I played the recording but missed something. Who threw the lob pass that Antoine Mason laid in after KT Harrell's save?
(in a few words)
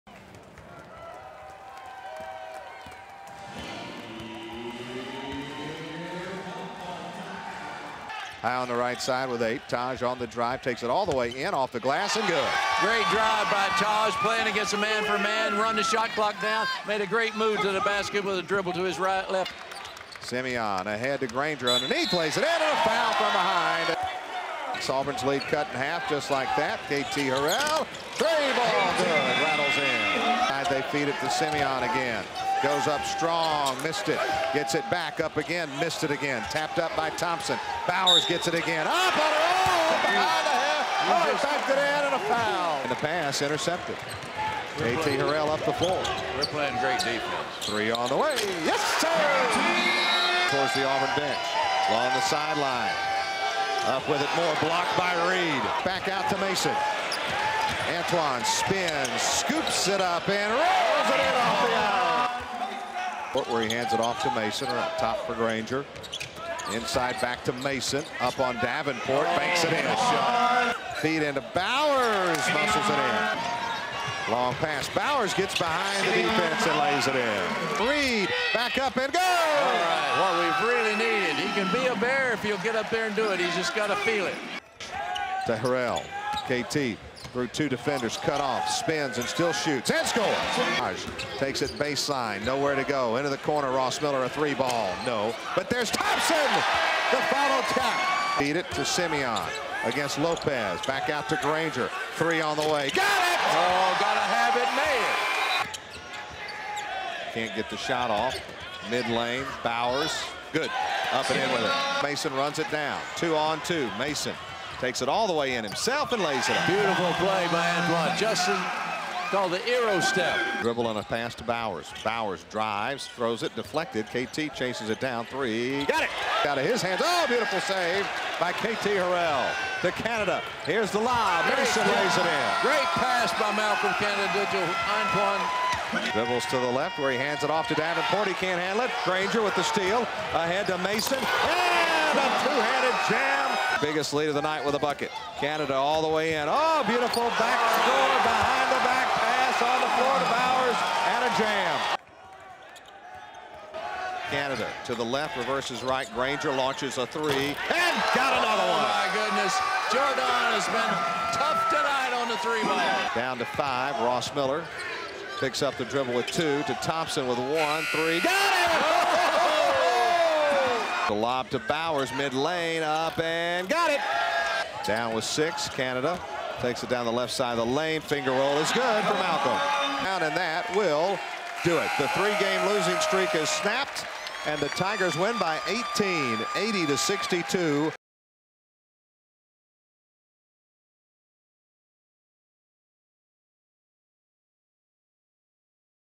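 Malcolm Canada.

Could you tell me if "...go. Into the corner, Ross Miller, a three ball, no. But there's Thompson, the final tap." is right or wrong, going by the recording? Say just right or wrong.
right.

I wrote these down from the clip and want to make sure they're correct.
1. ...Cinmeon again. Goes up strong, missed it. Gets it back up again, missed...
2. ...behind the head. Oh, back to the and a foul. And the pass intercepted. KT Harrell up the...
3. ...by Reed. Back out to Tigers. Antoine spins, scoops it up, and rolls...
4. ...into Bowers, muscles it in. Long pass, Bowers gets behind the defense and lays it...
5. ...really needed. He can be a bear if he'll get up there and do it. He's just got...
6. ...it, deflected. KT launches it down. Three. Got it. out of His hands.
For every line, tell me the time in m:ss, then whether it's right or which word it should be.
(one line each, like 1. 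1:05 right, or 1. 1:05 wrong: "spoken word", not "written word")
1. 0:31 right
2. 0:40 right
3. 0:54 wrong: "Mason", not "Tigers"
4. 1:11 right
5. 1:20 right
6. 2:03 wrong: "chases", not "launches".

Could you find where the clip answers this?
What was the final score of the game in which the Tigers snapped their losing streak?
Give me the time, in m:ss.
3:06.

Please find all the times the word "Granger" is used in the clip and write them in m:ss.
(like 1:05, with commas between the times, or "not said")
0:21, 1:05, 1:41, 2:19, 2:36.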